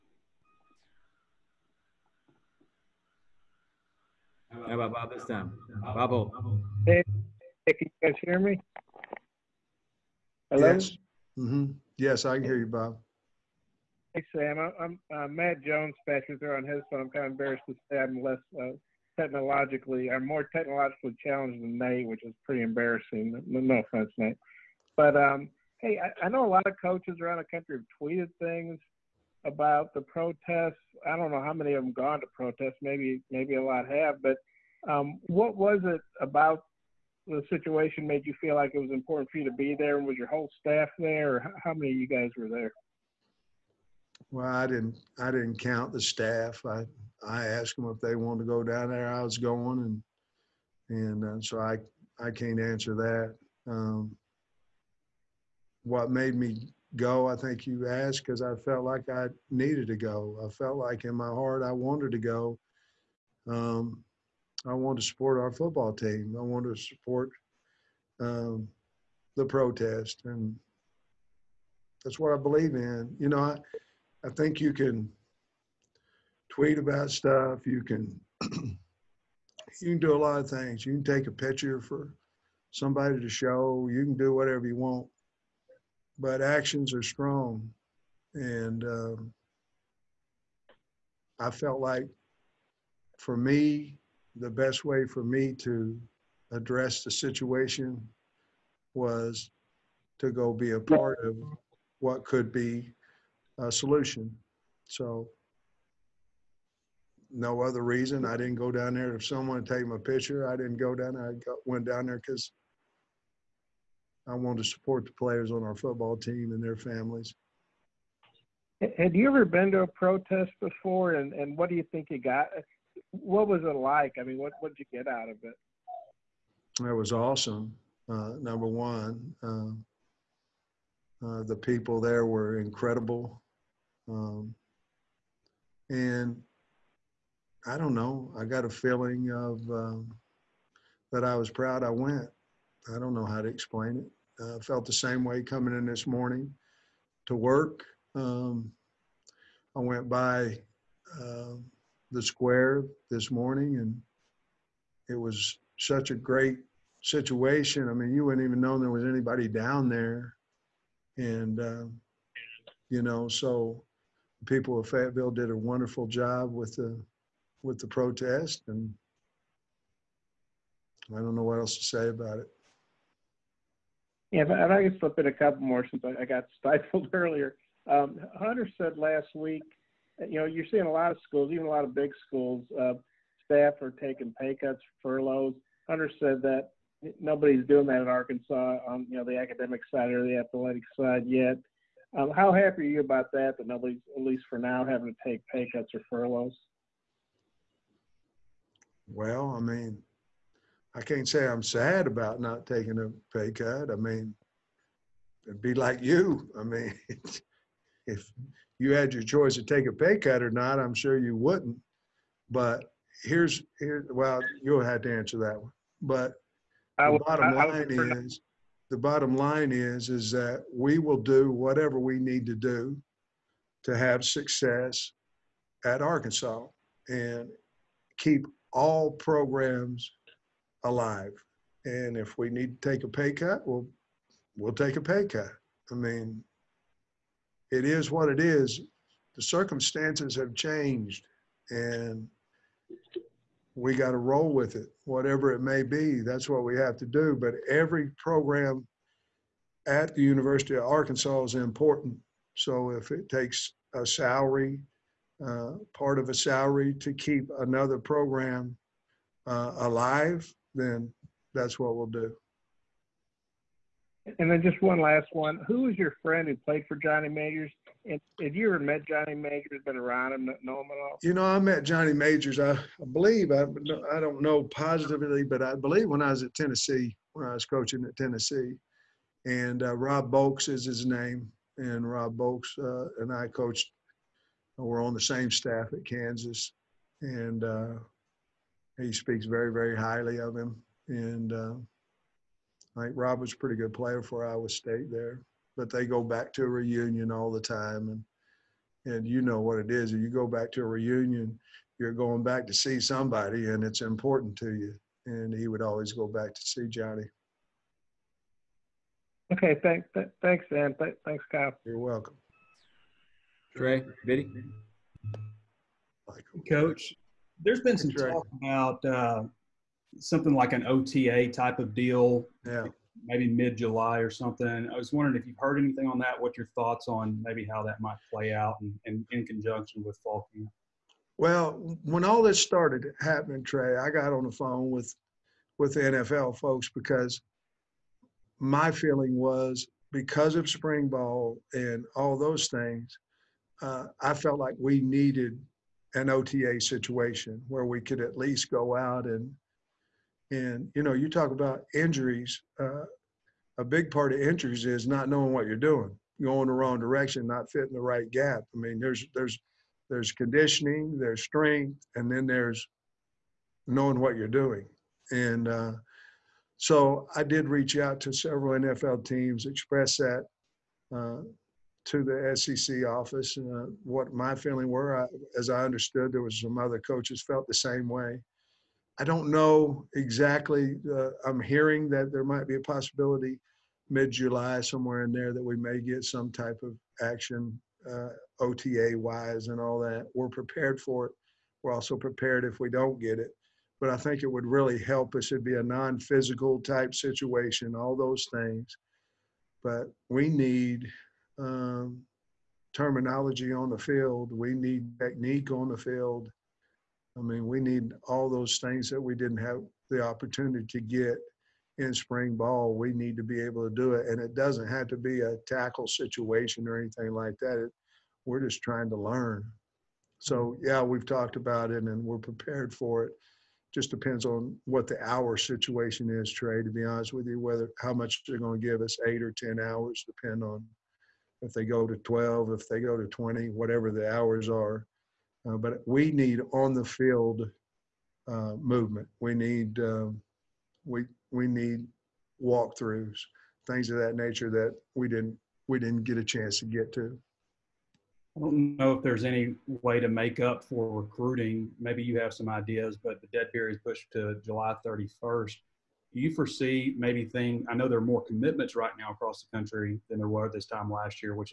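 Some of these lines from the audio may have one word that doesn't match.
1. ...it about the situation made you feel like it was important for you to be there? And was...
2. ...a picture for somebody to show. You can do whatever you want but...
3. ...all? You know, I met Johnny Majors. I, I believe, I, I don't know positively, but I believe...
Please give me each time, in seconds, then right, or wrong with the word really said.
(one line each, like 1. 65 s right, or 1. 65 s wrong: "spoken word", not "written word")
1. 35 s right
2. 81 s right
3. 271 s right.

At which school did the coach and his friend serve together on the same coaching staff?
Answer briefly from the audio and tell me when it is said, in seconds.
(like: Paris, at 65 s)
Kansas, at 286 s.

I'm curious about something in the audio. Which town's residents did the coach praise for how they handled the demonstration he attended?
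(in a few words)
Fayetteville.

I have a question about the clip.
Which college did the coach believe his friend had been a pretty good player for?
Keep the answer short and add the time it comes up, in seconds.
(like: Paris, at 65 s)
Iowa State, at 294 s.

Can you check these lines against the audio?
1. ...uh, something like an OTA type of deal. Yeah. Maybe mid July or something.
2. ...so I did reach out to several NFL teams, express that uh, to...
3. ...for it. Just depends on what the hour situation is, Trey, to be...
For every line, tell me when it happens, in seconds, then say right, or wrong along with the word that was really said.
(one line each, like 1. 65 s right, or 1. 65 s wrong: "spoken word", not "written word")
1. 319 s right
2. 366 s right
3. 422 s right.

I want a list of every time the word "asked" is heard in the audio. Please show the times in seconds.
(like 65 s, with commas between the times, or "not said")
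47 s, 57 s.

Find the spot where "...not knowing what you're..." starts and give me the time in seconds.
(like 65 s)
355 s.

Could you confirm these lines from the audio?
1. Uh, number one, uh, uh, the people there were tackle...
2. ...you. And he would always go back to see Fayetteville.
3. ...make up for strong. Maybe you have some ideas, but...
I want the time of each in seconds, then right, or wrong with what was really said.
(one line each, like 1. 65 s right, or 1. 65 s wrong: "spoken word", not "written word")
1. 128 s wrong: "incredible", not "tackle"
2. 304 s wrong: "Johnny", not "Fayetteville"
3. 450 s wrong: "recruiting", not "strong".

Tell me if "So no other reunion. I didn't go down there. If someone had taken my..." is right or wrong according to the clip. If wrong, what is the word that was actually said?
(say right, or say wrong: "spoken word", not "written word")
wrong: "reason", not "reunion".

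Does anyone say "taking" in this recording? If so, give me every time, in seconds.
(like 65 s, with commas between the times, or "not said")
183 s, 202 s.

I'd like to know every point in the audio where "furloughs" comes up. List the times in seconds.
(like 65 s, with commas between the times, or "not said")
185 s, 196 s.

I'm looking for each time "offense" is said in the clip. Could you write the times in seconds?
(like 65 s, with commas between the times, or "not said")
23 s.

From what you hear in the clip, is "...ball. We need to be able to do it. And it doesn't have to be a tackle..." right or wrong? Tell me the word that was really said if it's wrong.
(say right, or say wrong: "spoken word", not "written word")
right.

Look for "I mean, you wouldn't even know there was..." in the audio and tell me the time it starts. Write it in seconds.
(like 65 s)
157 s.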